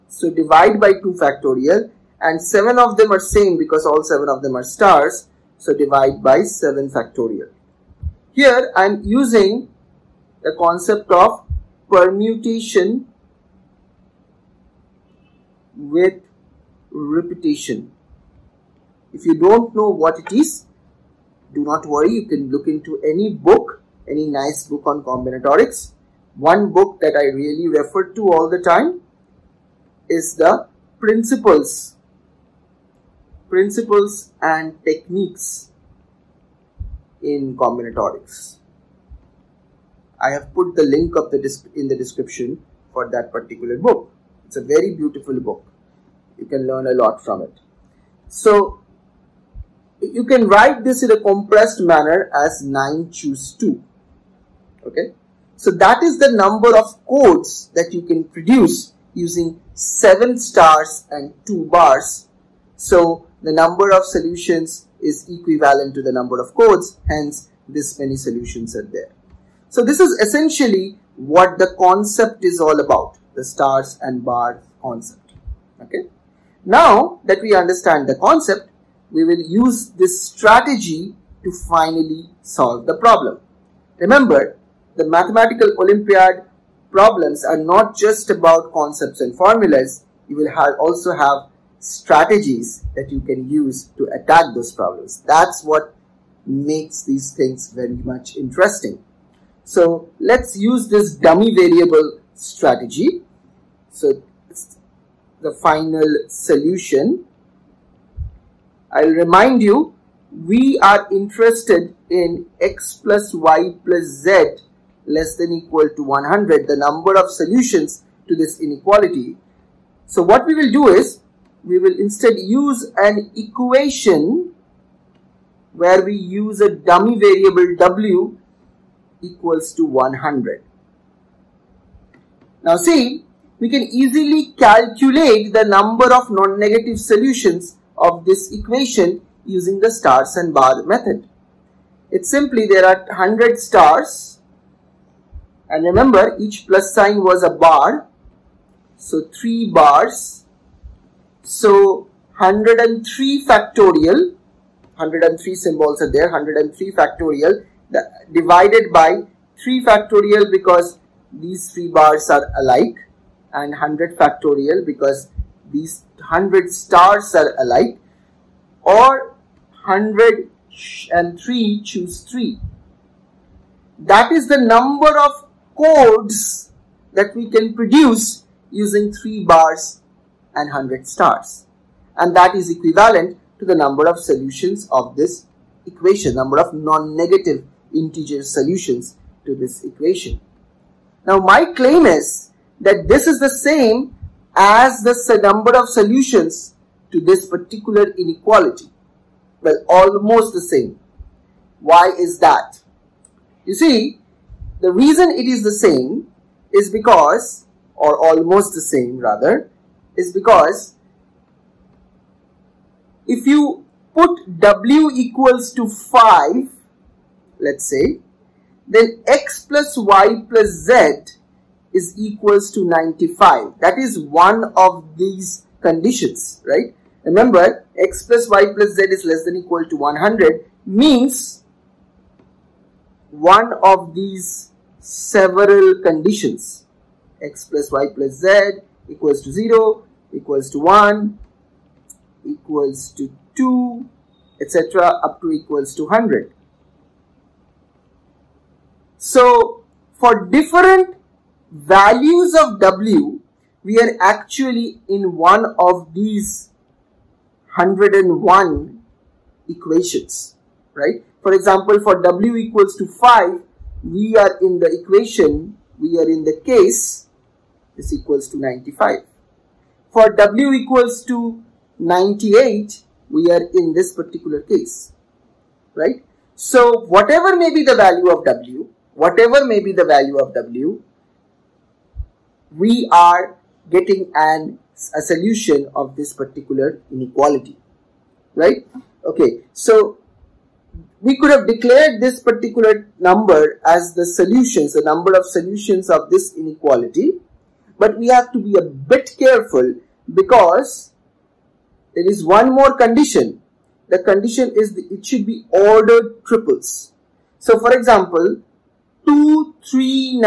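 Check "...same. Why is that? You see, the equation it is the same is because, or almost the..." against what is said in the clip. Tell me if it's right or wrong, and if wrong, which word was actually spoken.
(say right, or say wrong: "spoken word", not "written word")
wrong: "reason", not "equation".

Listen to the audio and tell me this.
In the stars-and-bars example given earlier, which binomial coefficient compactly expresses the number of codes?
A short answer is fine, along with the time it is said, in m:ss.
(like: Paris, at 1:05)
9 choose 2, at 0:52.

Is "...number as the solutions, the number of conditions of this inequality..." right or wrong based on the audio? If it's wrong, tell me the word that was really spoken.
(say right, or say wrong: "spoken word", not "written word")
wrong: "solutions", not "conditions".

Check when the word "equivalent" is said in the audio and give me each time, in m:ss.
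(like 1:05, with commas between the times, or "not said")
1:05, 3:02.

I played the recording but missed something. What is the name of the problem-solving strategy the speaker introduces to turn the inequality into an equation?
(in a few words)
dummy variable strategy.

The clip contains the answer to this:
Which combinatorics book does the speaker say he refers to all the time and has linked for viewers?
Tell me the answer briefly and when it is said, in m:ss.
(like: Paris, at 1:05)
Principles and Techniques in Combinatorics, at 0:33.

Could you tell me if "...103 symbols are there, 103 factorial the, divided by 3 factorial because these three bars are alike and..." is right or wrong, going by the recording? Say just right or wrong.
right.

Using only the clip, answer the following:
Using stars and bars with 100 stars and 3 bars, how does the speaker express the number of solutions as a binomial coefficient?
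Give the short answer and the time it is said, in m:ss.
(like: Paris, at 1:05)
103 choose 3, at 2:49.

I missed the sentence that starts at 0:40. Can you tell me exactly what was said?
I have put the link of the in the description for that particular book.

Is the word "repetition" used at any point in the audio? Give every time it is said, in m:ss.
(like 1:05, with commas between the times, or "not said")
0:16.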